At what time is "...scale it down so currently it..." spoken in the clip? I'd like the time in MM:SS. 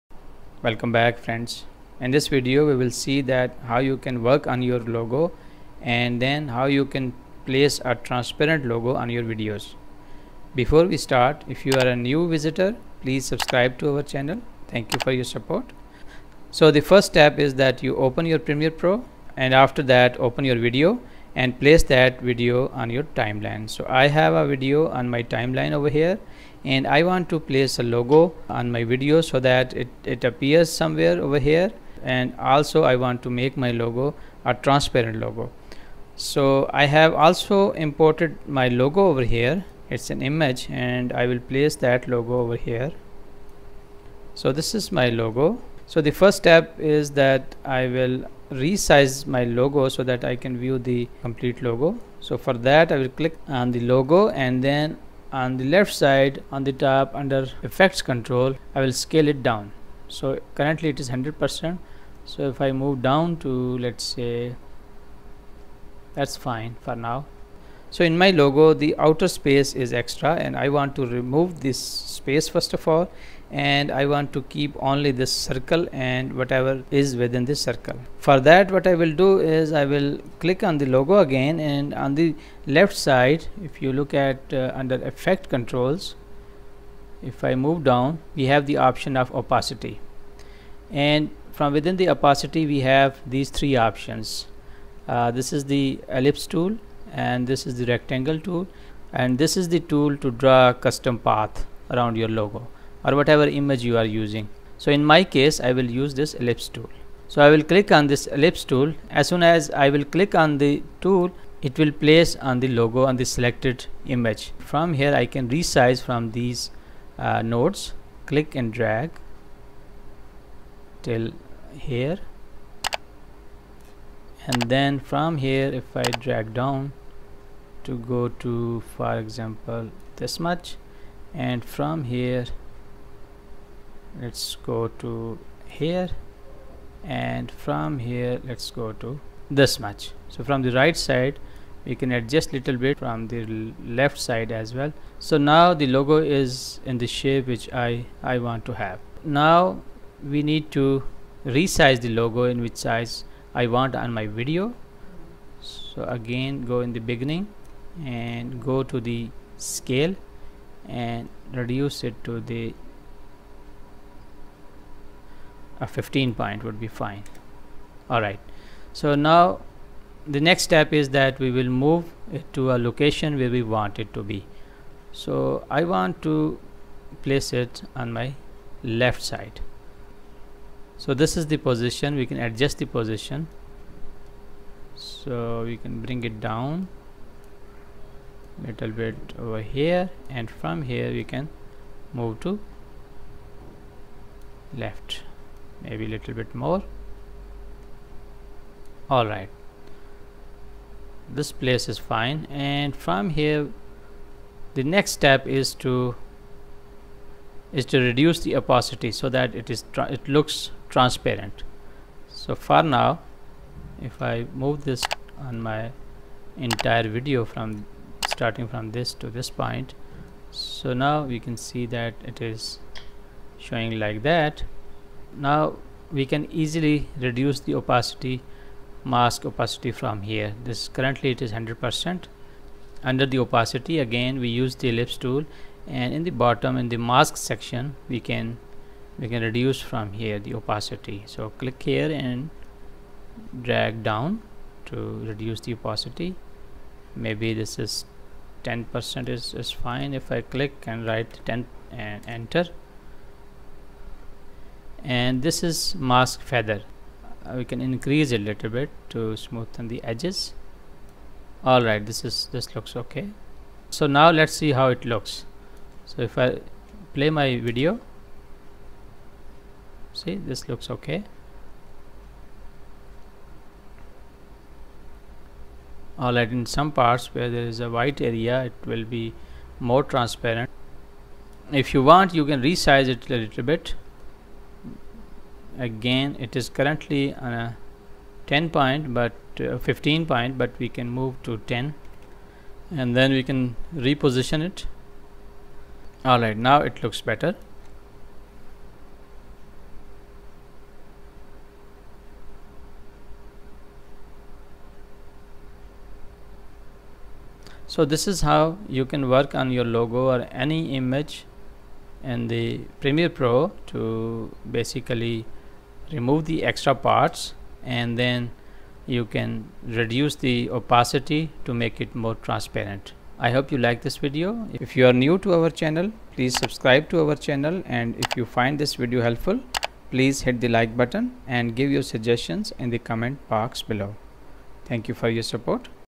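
00:58.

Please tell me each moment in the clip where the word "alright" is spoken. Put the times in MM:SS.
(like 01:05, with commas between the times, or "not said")
02:48, 03:19, 04:21, 04:56.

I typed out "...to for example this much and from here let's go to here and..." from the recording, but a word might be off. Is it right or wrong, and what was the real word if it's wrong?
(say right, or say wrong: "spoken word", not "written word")
right.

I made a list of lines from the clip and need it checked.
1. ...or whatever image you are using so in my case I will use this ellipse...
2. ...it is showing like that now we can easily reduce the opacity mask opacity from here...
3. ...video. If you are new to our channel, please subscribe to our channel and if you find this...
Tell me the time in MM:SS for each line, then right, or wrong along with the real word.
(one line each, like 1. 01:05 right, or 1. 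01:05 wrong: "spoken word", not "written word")
1. 01:43 right
2. 03:42 right
3. 05:24 right.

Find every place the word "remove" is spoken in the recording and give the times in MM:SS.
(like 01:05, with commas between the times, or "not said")
01:11, 05:16.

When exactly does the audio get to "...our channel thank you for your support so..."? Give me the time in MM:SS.
00:13.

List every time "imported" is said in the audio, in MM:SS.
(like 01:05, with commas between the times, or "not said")
00:37.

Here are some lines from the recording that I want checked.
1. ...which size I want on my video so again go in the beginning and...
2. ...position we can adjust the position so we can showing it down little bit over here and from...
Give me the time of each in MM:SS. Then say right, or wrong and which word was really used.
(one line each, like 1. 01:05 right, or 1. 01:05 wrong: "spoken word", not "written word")
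1. 02:32 right
2. 03:01 wrong: "bring", not "showing".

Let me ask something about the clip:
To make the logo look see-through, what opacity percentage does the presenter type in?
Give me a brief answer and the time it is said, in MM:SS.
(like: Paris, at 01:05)
10 percent, at 04:08.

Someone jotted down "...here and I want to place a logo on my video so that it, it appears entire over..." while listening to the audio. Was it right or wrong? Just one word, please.
wrong.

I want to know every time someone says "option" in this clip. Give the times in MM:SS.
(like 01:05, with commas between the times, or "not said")
01:28, 01:33.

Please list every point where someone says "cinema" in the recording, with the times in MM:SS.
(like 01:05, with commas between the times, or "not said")
not said.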